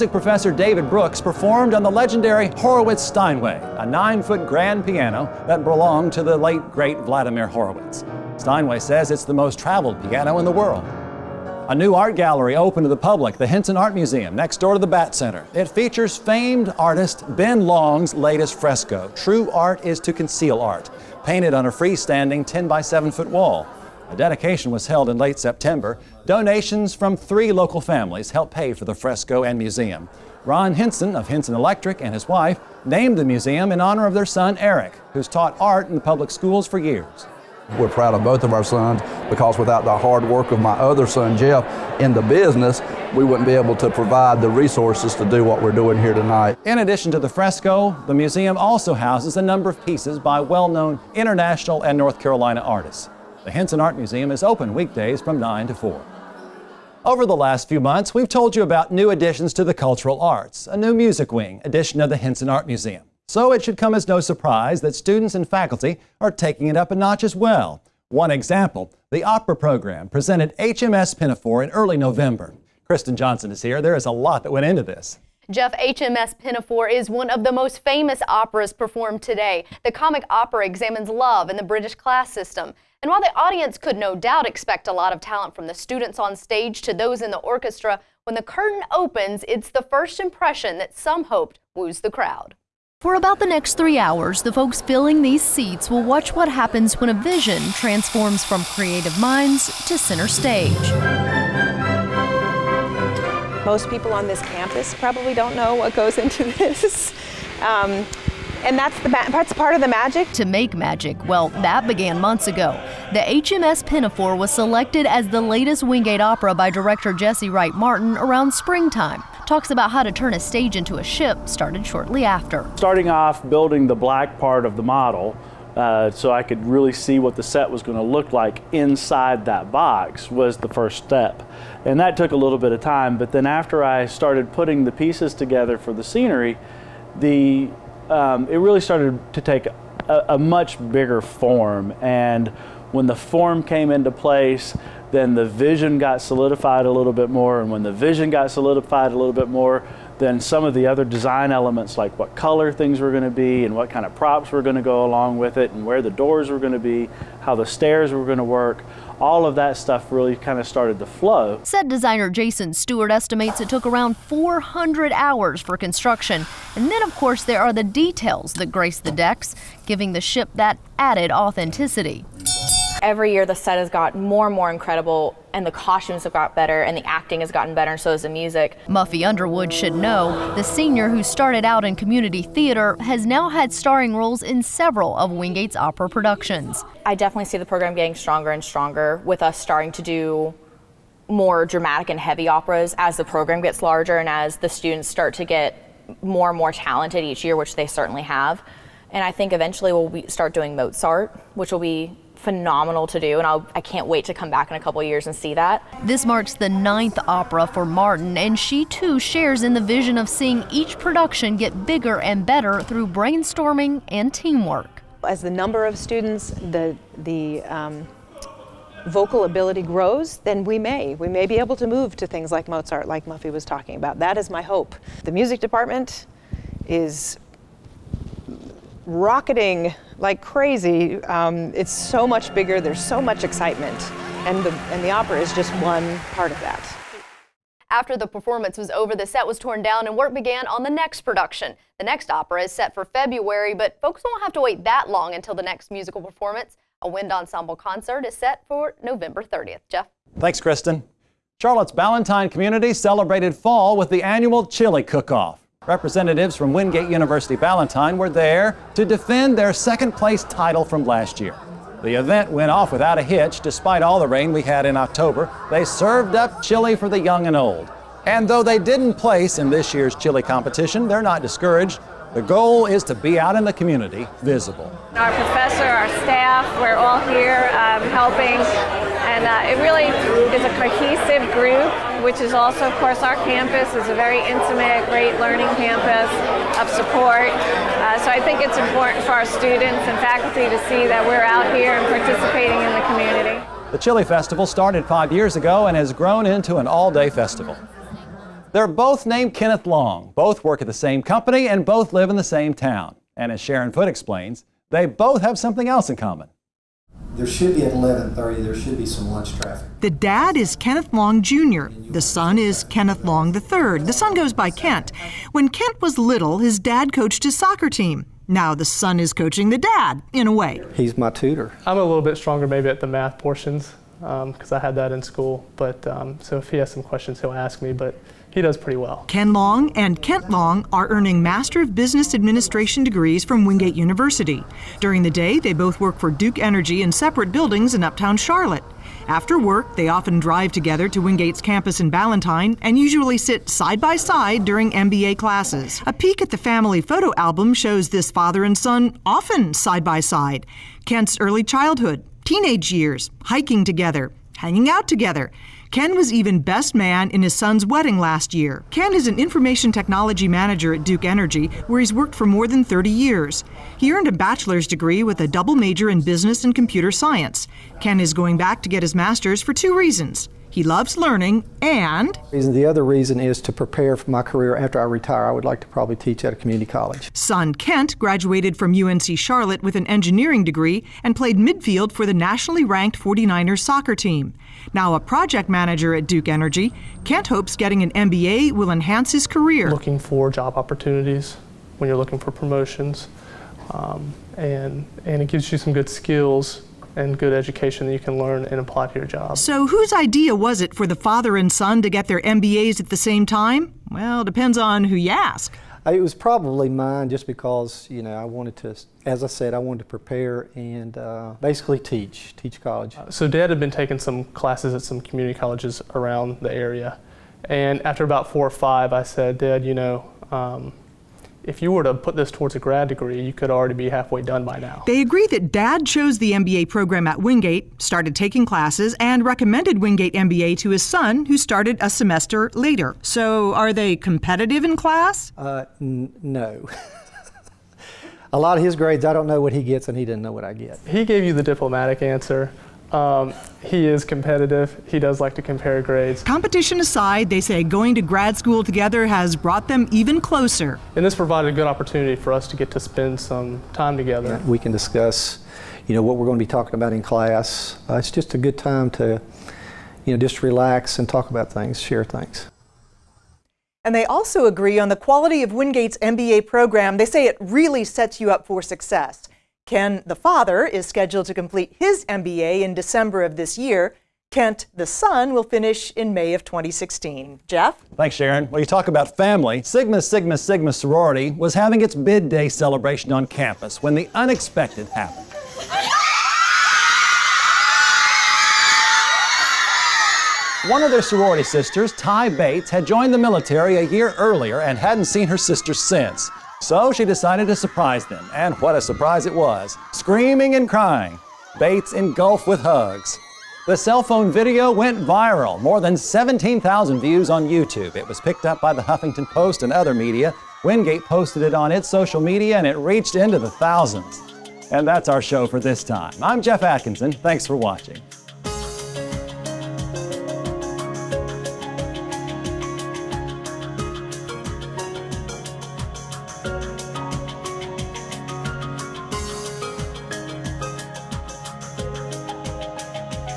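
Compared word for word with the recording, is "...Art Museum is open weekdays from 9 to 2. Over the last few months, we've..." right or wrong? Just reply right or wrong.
wrong.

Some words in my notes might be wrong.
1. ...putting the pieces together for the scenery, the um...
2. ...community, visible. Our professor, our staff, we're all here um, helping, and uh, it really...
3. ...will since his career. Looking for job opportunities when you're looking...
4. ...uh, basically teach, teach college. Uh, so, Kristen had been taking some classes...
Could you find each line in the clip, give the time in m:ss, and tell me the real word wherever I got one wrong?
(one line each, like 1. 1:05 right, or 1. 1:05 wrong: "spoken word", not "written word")
1. 2:14 right
2. 4:33 right
3. 6:28 wrong: "enhance", not "since"
4. 6:51 wrong: "Dad", not "Kristen".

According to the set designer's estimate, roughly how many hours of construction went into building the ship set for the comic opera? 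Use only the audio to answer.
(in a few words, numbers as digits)
400.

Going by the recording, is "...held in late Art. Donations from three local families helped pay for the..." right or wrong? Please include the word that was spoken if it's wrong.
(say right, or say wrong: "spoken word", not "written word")
wrong: "September", not "Art".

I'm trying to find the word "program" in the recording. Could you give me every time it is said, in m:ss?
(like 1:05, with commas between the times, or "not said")
1:09, 3:07, 3:13, 7:06, 7:46.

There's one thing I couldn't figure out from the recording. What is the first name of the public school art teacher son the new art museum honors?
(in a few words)
Eric.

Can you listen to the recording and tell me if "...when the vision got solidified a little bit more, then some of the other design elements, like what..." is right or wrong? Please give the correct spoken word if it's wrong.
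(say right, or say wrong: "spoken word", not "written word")
right.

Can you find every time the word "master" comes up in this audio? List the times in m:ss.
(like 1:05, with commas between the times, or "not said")
5:31, 6:09.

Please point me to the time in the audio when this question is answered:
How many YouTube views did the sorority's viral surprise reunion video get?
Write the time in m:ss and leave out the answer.
8:26.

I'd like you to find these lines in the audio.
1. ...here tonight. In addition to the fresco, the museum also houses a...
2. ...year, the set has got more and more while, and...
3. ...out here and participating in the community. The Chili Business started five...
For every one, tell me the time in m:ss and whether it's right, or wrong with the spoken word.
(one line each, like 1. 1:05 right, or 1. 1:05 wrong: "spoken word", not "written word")
1. 0:46 right
2. 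2:53 wrong: "incredible", not "while"
3. 4:51 wrong: "Festival", not "Business".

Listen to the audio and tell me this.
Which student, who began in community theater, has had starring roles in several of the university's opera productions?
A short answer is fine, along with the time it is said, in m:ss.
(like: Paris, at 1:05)
Muffy Underwood, at 2:58.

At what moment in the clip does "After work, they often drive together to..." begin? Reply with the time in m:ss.
5:39.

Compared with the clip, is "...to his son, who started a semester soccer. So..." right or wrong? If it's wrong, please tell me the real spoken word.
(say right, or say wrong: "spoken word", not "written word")
wrong: "later", not "soccer".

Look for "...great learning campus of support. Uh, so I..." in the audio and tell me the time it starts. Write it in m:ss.
4:45.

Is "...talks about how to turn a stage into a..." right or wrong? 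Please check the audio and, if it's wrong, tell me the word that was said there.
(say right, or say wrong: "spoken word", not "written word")
right.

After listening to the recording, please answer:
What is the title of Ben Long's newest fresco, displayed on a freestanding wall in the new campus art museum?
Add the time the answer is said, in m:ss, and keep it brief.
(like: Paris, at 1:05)
True Art is to Conceal Art, at 0:19.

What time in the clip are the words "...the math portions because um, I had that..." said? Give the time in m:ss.
5:23.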